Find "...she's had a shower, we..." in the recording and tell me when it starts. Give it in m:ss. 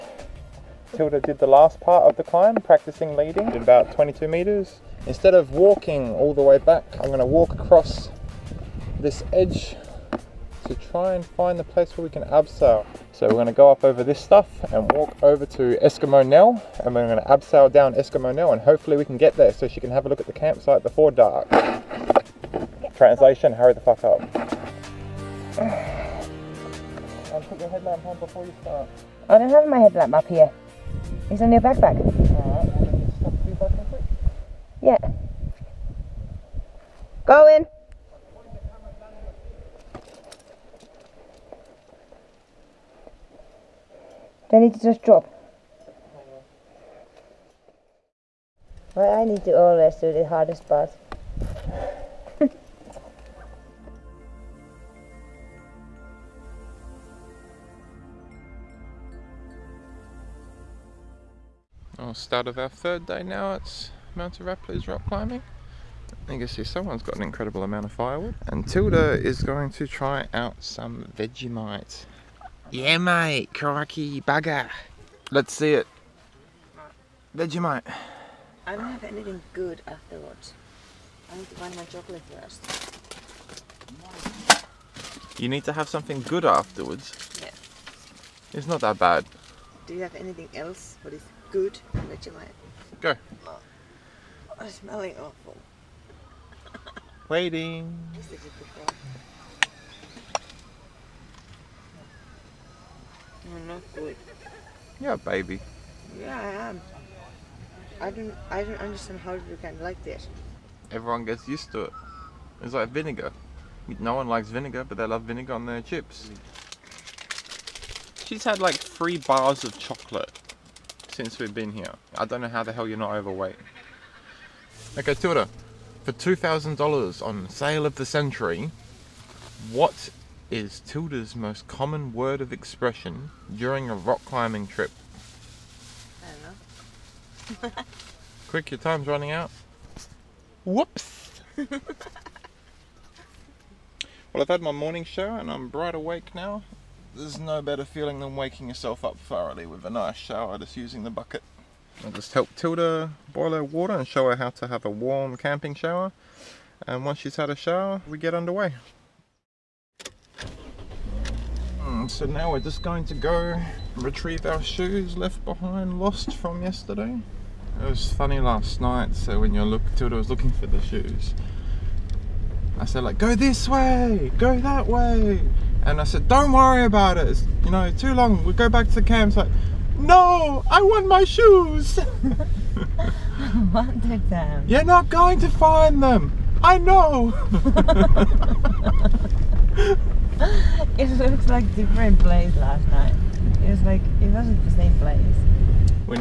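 2:37.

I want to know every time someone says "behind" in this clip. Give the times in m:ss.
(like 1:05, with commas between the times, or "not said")
2:45.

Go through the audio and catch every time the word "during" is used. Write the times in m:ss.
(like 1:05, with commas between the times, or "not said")
2:13.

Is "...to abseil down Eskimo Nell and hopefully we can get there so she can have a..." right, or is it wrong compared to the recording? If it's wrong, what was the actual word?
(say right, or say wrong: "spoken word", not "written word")
right.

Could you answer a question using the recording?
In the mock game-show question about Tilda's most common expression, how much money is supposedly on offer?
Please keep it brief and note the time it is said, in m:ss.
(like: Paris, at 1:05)
$2,000, at 2:06.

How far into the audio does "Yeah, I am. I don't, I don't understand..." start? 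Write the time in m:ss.
1:46.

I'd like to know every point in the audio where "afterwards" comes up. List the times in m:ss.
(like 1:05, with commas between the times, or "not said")
1:19, 1:26.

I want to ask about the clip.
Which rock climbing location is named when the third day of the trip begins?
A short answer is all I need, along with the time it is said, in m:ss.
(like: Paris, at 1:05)
Mount Arapiles, at 1:04.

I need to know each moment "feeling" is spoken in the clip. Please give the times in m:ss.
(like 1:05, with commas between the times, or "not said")
2:27.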